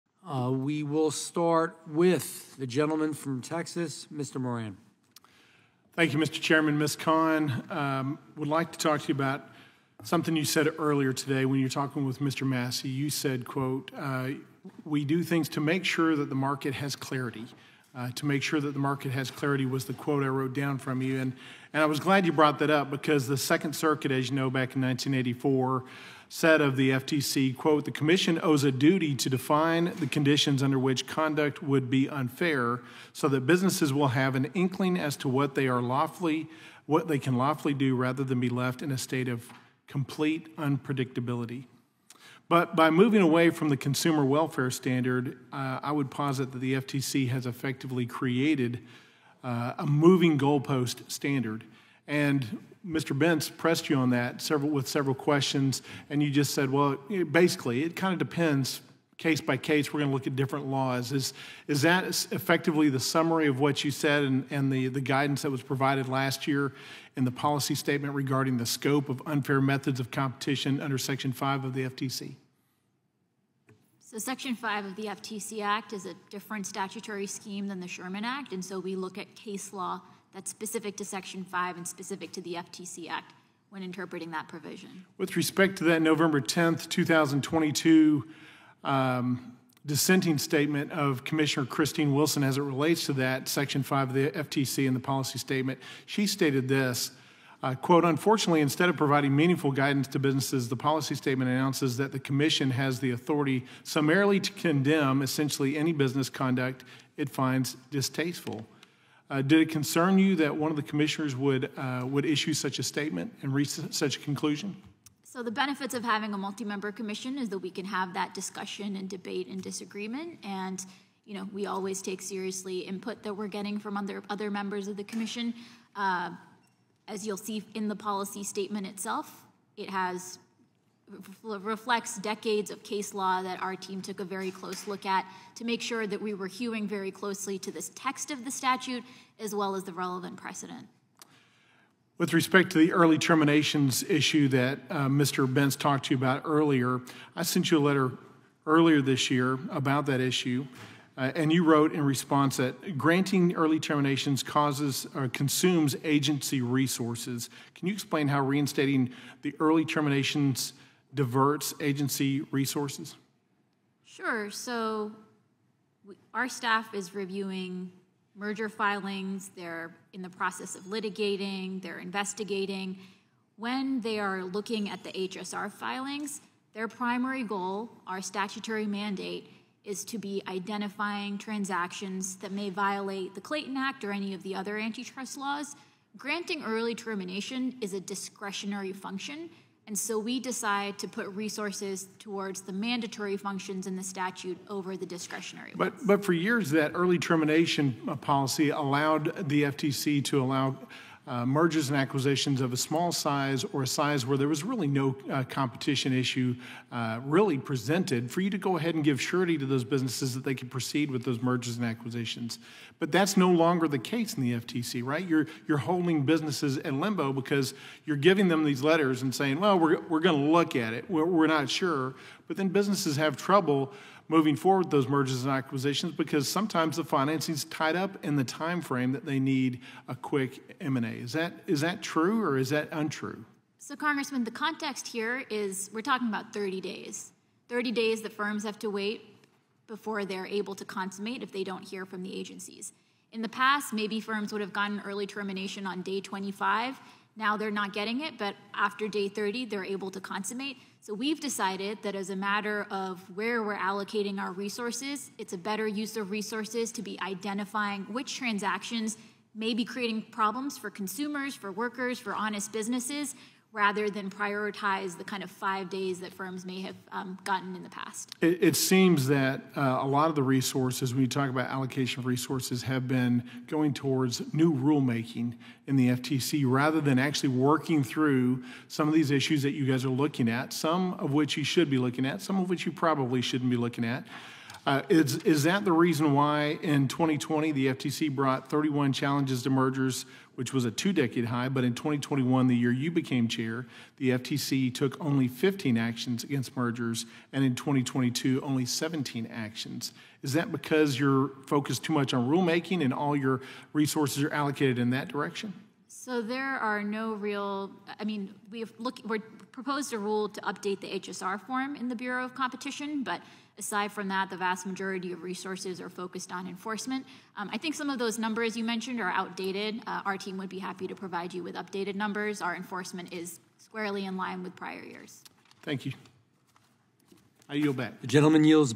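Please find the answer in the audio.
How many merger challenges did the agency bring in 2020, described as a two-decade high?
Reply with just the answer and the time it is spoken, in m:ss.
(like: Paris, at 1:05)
31, at 4:48.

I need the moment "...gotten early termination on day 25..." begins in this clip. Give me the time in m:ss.
4:04.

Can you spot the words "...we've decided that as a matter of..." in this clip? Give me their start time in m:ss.
4:11.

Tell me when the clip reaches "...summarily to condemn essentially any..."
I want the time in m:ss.
1:43.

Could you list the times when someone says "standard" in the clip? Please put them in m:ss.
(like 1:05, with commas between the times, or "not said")
0:44, 0:51.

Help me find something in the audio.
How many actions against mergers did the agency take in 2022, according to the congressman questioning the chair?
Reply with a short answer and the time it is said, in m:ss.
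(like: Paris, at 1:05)
17, at 4:58.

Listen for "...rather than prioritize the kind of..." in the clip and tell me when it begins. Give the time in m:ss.
4:23.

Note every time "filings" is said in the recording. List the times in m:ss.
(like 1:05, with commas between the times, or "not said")
2:48, 2:55.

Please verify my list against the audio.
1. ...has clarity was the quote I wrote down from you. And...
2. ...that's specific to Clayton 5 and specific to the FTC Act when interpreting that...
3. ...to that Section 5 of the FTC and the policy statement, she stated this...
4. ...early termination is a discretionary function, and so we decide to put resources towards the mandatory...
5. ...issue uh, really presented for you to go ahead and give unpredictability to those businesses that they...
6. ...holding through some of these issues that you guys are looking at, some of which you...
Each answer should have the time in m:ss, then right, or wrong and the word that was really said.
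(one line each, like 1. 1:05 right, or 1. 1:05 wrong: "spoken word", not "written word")
1. 0:19 right
2. 1:20 wrong: "Section", not "Clayton"
3. 1:33 right
4. 3:06 right
5. 3:26 wrong: "surety", not "unpredictability"
6. 4:37 wrong: "working", not "holding".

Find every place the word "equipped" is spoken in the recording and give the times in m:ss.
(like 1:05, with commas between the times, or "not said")
not said.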